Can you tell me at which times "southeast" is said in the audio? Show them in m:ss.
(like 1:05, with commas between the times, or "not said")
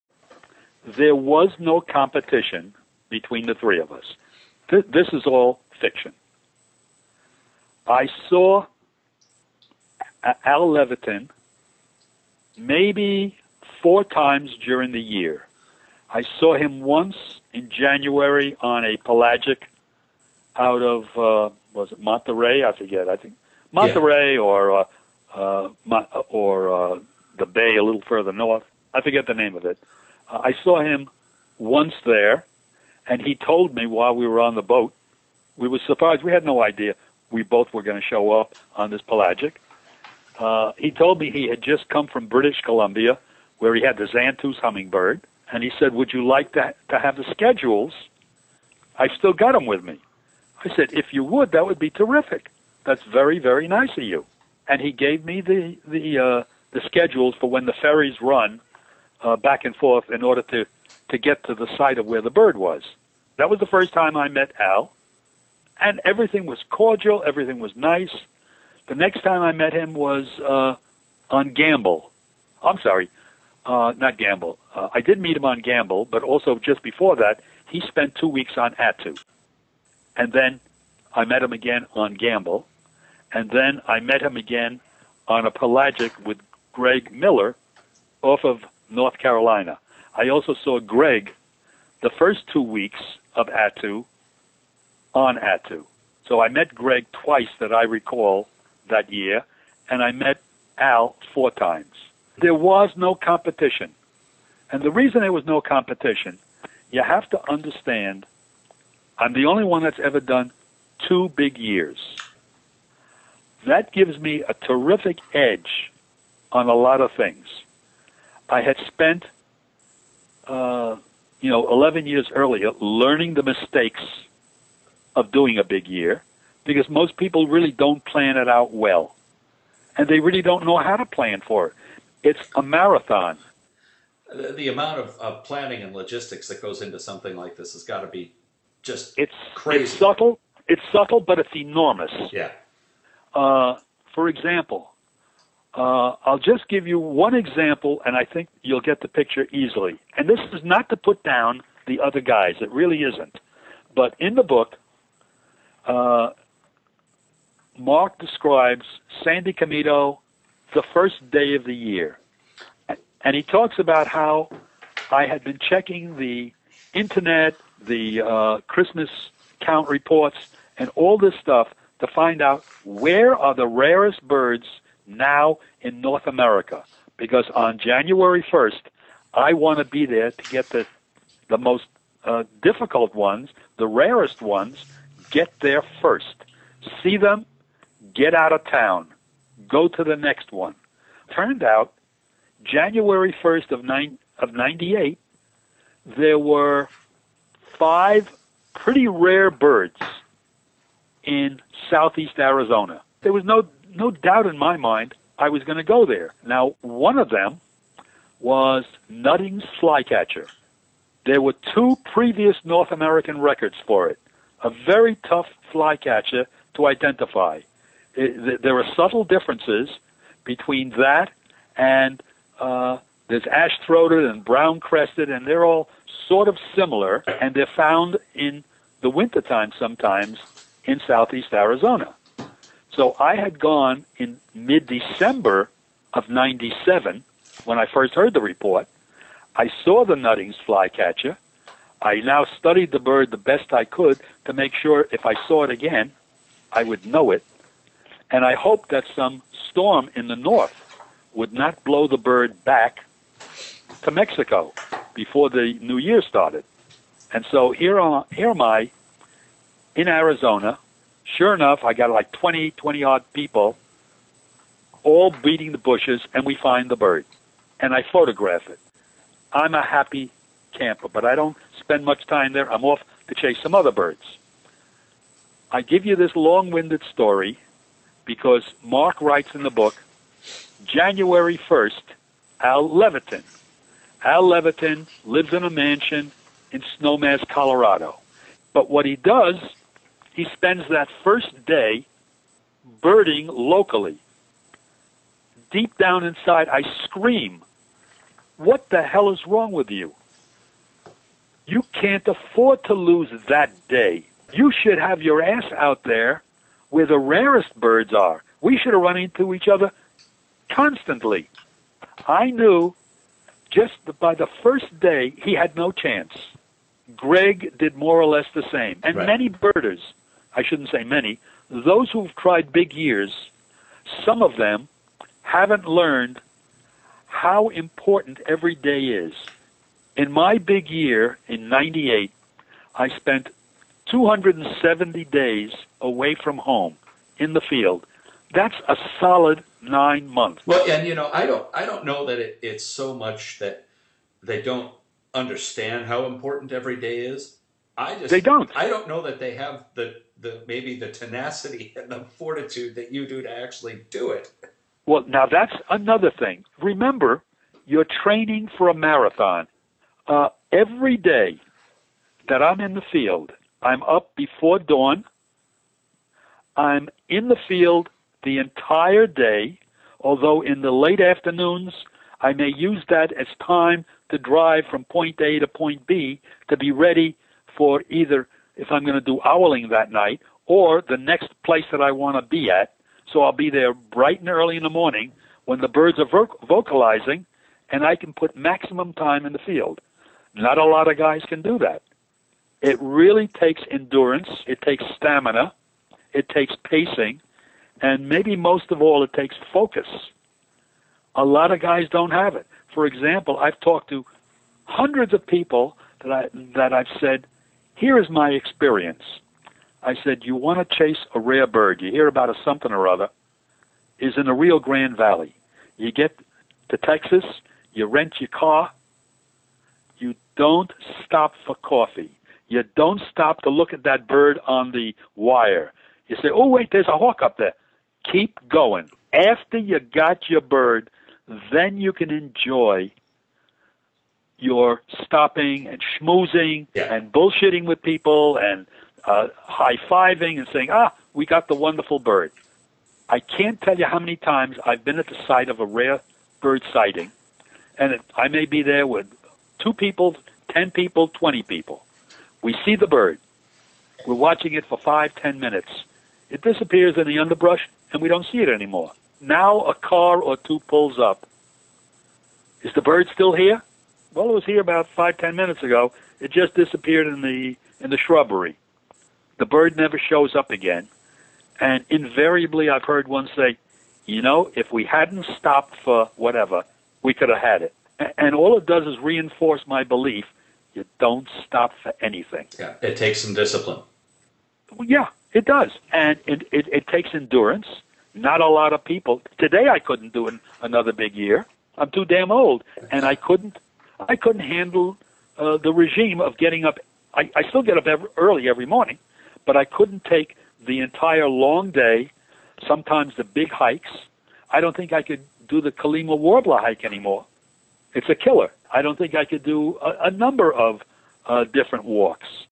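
3:21, 3:51.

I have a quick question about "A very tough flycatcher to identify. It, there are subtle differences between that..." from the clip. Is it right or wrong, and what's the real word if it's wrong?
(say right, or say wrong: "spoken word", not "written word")
right.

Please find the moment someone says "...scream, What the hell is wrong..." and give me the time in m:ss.
4:57.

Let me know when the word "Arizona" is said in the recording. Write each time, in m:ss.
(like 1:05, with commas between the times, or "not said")
3:22, 3:51, 4:20.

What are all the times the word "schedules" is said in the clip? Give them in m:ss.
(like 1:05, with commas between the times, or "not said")
0:47, 0:56.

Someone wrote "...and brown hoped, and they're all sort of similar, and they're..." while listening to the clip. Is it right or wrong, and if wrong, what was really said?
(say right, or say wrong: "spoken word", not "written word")
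wrong: "crested", not "hoped".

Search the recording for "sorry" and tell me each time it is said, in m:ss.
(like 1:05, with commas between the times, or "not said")
1:12.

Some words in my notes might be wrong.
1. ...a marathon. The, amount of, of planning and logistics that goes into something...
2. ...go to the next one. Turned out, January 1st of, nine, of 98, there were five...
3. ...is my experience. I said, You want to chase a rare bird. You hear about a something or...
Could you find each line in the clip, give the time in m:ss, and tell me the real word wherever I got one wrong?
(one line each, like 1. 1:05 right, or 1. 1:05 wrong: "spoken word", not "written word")
1. 2:12 right
2. 3:09 right
3. 6:48 right.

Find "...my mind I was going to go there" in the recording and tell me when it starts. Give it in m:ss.
3:24.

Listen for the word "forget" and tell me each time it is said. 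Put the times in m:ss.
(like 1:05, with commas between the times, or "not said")
0:22, 0:29.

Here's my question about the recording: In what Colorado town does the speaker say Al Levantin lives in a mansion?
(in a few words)
Snowmass.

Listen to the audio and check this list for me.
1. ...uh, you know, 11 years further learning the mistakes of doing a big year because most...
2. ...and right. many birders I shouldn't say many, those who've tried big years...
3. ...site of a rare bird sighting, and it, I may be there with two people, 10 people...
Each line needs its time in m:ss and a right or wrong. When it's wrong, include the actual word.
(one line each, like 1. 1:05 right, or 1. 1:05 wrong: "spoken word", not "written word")
1. 2:00 wrong: "earlier", not "further"
2. 5:19 right
3. 7:25 right.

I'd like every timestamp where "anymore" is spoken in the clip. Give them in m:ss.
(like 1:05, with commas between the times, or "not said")
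7:38, 8:27.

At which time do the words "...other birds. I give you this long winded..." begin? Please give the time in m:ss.
4:33.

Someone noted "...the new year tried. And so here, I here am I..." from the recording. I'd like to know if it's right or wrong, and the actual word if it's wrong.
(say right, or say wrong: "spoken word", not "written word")
wrong: "started", not "tried".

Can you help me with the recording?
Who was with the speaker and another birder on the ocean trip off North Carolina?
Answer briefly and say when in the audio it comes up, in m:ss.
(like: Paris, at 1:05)
Greg Miller, at 1:26.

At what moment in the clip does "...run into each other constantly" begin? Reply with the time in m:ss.
5:09.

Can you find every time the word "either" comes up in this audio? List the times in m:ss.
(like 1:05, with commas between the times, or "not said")
6:18.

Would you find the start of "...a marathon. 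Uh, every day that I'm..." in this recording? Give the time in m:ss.
5:58.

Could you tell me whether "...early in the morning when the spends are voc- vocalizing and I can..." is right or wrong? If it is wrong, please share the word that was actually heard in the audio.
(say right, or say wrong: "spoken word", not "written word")
wrong: "birds", not "spends".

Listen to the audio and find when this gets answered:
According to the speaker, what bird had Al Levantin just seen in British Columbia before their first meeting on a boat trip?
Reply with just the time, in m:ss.
0:44.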